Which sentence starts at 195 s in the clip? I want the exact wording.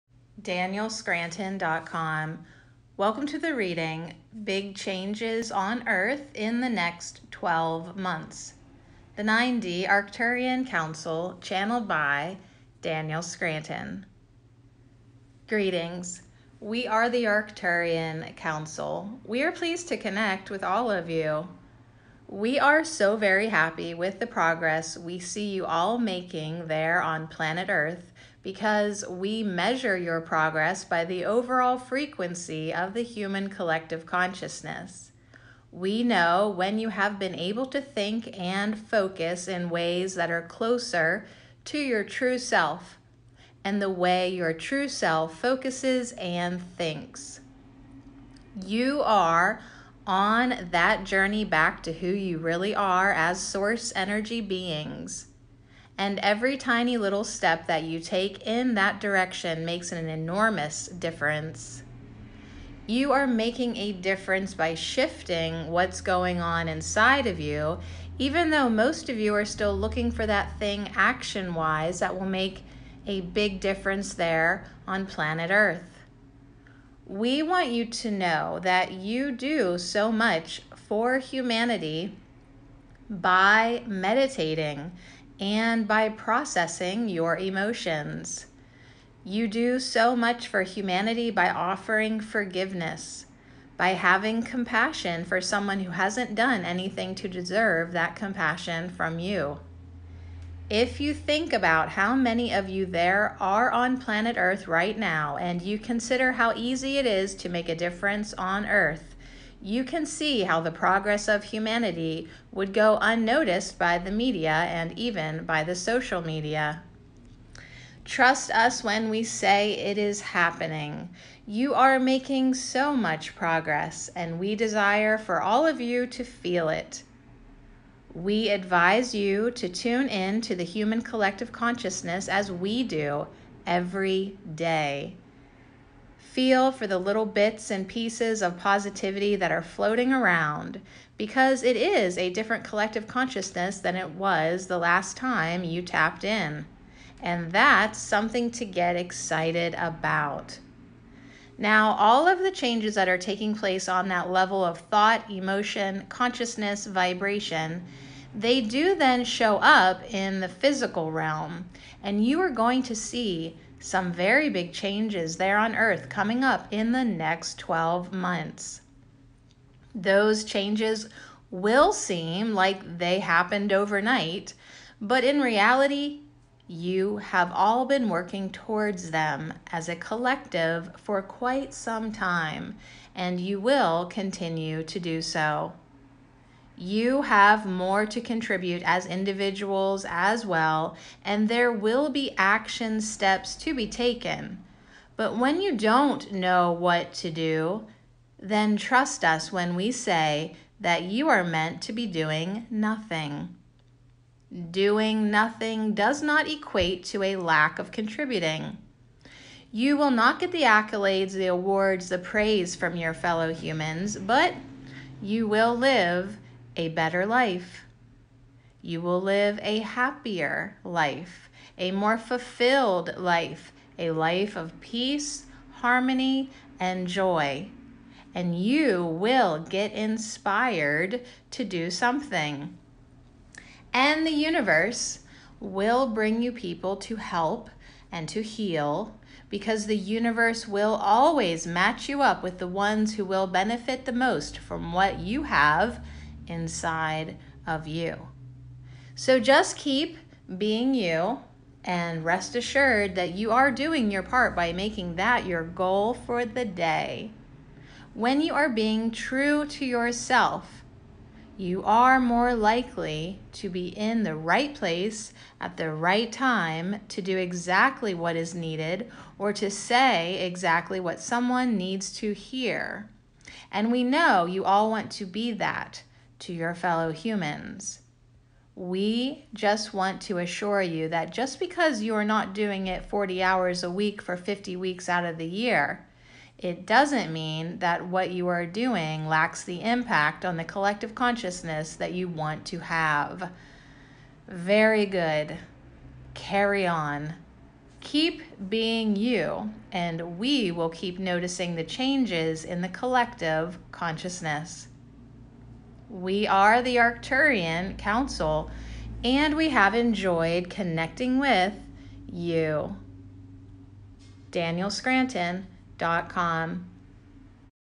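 But when you don't know what to do, then trust us when we say that you are meant to be doing nothing.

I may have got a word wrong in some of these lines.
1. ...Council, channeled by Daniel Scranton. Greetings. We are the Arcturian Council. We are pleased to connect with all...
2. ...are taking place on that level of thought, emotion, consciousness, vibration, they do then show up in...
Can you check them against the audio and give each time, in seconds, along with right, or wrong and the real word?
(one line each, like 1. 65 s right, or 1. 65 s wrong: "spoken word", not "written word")
1. 10 s right
2. 153 s right.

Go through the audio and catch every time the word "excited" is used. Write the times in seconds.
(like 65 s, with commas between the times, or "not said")
148 s.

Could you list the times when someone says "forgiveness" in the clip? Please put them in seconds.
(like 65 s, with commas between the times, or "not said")
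92 s.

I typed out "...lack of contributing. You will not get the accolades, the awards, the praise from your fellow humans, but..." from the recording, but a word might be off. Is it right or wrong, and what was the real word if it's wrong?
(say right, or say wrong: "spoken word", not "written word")
right.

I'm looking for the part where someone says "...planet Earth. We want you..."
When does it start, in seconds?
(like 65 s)
75 s.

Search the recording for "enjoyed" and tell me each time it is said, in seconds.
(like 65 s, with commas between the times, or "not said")
309 s.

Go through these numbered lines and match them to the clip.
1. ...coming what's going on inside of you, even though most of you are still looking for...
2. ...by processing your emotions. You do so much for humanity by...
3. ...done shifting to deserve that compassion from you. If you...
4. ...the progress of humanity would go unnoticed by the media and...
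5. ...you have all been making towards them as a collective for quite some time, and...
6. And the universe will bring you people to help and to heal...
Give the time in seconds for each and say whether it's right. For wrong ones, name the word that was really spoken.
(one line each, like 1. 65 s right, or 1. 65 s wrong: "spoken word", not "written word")
1. 64 s wrong: "shifting", not "coming"
2. 85 s right
3. 96 s wrong: "anything", not "shifting"
4. 110 s right
5. 176 s wrong: "working", not "making"
6. 233 s right.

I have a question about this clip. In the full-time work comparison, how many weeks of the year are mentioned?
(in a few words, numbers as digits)
50.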